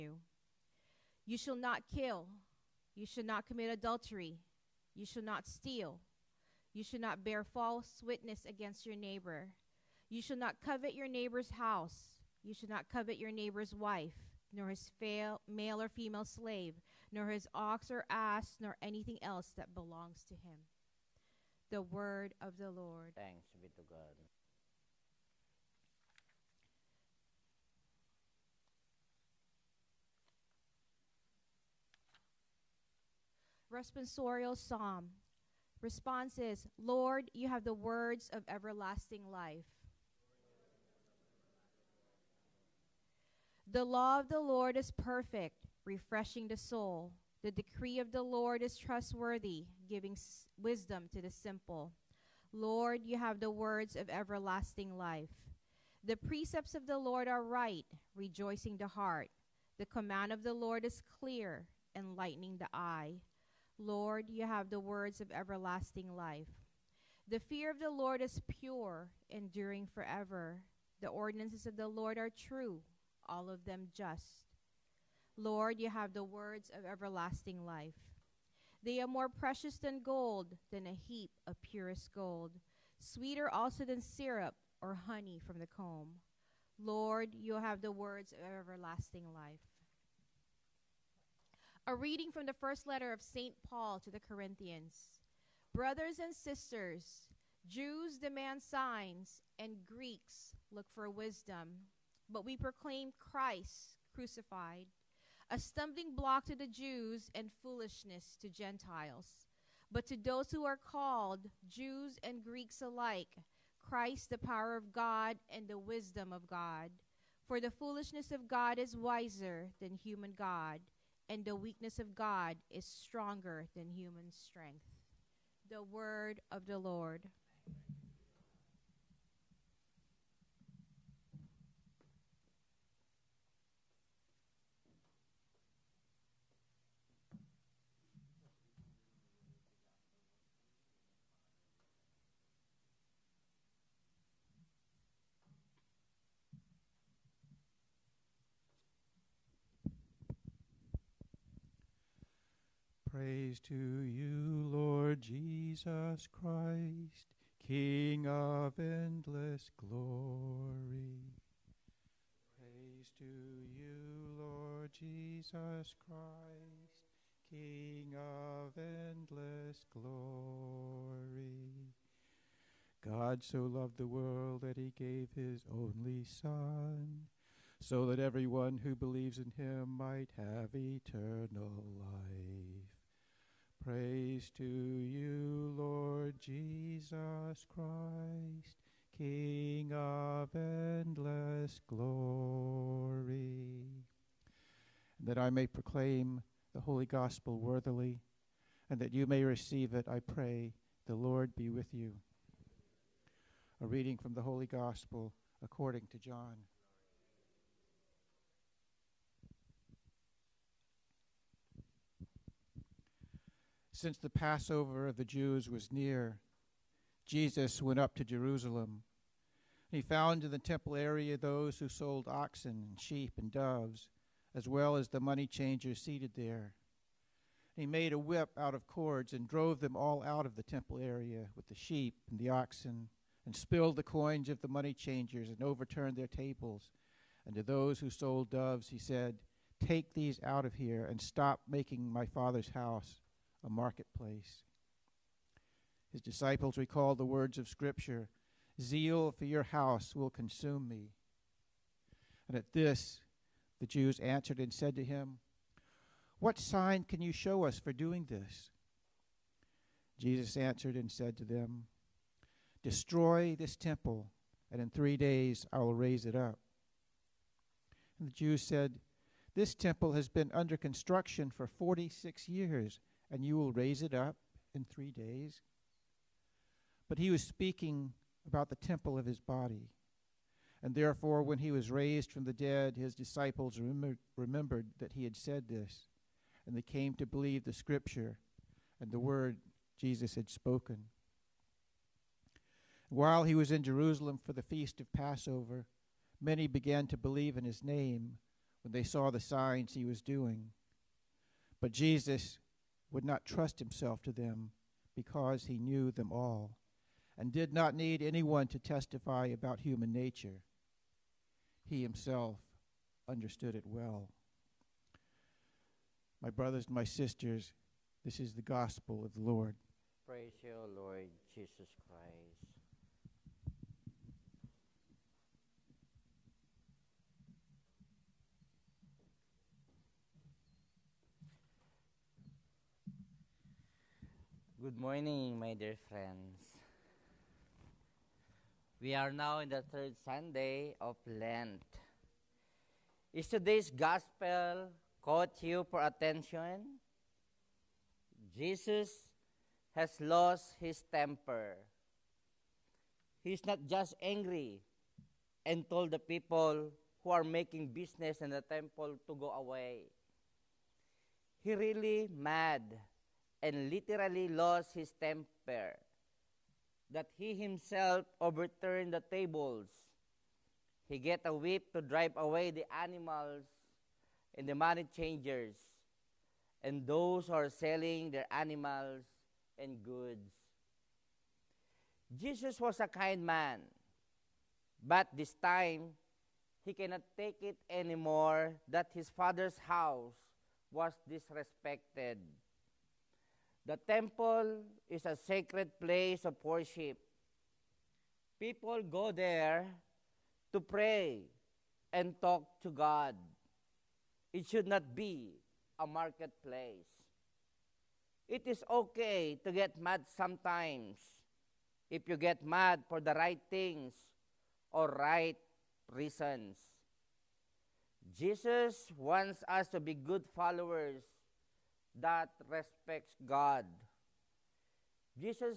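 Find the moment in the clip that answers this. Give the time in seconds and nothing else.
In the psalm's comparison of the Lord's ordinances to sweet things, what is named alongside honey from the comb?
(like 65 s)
84 s.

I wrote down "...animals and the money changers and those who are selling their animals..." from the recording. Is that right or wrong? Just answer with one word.
right.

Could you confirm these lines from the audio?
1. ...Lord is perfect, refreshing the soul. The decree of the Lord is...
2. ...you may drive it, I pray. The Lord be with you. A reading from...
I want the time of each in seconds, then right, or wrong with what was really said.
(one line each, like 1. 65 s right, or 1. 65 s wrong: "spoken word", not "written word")
1. 44 s right
2. 199 s wrong: "receive", not "drive".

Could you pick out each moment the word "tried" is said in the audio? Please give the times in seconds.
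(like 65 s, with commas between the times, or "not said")
not said.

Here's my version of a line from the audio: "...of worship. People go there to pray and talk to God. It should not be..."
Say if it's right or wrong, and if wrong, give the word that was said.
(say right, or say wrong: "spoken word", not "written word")
right.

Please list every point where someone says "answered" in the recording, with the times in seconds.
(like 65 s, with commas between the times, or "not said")
254 s, 260 s.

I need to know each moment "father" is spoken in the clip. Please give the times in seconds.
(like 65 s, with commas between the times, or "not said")
242 s, 389 s.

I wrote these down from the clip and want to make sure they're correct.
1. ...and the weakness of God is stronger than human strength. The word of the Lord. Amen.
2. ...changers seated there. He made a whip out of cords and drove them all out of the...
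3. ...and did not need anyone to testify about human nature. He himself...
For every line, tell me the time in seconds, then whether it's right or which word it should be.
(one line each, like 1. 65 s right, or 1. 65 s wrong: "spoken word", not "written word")
1. 121 s right
2. 225 s right
3. 307 s right.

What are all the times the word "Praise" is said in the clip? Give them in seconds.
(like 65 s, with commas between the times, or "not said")
153 s, 162 s, 183 s, 320 s.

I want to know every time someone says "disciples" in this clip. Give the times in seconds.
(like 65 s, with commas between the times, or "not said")
246 s, 283 s.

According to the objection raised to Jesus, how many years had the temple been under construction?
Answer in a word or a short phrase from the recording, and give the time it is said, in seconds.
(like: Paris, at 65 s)
46, at 271 s.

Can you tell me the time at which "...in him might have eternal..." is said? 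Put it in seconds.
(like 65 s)
179 s.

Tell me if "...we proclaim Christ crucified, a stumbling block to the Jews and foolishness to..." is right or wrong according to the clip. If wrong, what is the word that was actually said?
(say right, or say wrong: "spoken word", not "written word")
right.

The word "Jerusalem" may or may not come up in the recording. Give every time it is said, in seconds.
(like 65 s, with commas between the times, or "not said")
218 s, 293 s.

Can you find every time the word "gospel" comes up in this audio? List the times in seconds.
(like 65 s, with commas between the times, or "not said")
197 s, 204 s, 318 s, 343 s.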